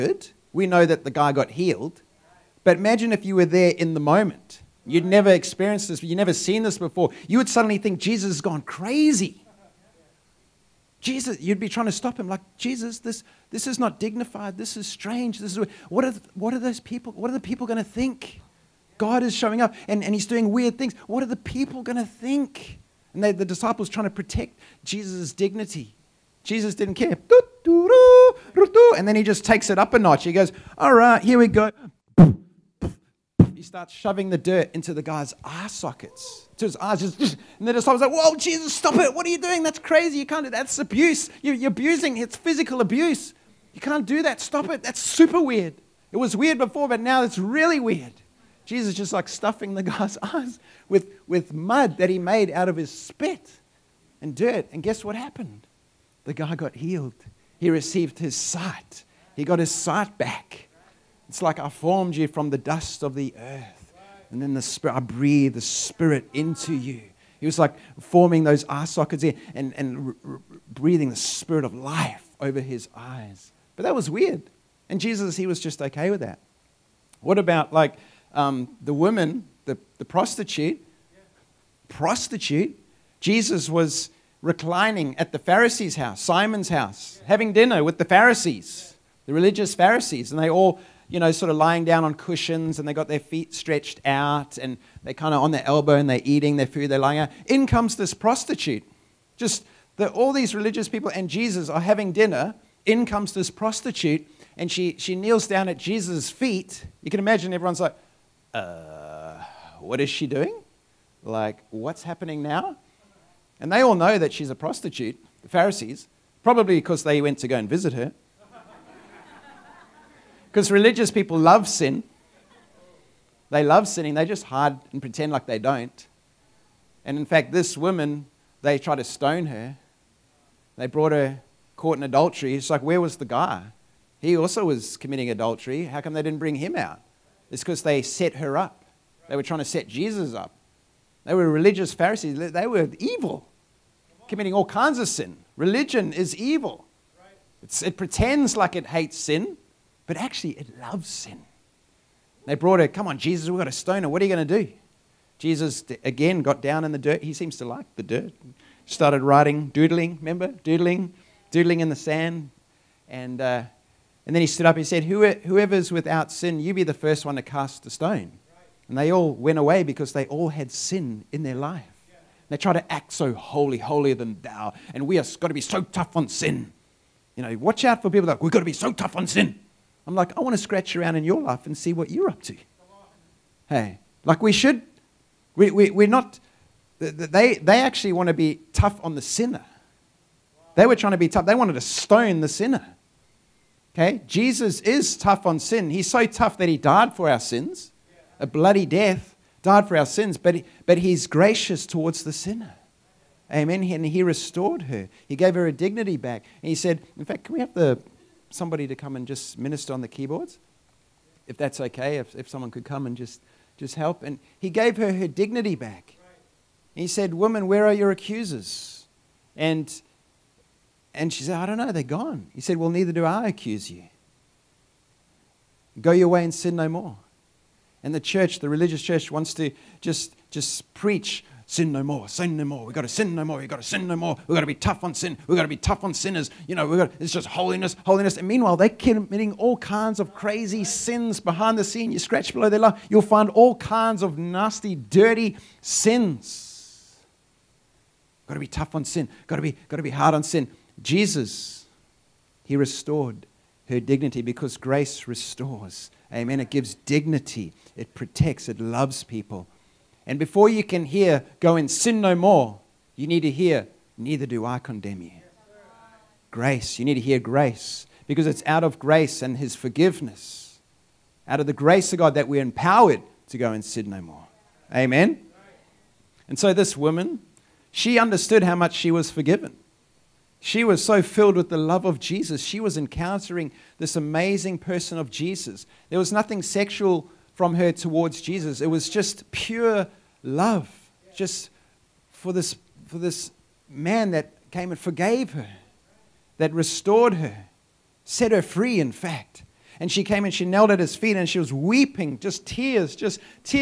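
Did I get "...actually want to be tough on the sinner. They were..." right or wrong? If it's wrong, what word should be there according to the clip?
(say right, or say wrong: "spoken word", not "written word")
right.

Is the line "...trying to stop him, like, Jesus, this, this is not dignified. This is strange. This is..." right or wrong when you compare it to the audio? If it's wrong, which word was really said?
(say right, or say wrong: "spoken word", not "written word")
right.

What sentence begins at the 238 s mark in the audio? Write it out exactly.
And meanwhile, they're committing all kinds of crazy sins behind the scene.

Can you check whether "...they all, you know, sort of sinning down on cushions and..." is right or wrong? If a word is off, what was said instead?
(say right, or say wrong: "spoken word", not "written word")
wrong: "lying", not "sinning".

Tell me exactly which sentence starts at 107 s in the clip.
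You can imagine everyone's like, uh, what is she doing?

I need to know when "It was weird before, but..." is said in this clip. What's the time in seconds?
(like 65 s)
46 s.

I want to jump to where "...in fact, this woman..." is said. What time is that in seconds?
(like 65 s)
127 s.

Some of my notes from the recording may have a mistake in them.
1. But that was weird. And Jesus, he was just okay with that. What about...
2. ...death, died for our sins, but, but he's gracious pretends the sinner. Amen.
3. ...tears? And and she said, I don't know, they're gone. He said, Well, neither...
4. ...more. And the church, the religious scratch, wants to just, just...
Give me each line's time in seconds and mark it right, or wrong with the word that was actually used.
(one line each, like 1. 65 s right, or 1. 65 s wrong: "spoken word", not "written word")
1. 73 s right
2. 198 s wrong: "towards", not "pretends"
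3. 218 s wrong: "accusers", not "tears"
4. 226 s wrong: "church", not "scratch".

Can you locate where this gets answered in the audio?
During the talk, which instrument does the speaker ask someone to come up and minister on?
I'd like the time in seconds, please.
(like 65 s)
210 s.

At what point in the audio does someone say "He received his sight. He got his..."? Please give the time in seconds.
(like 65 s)
57 s.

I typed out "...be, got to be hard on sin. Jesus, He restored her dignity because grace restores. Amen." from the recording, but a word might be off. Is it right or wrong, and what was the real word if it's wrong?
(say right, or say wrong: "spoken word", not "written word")
right.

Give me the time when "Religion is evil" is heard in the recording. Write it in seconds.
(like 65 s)
145 s.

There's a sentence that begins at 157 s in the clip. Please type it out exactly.
He seems to like the dirt.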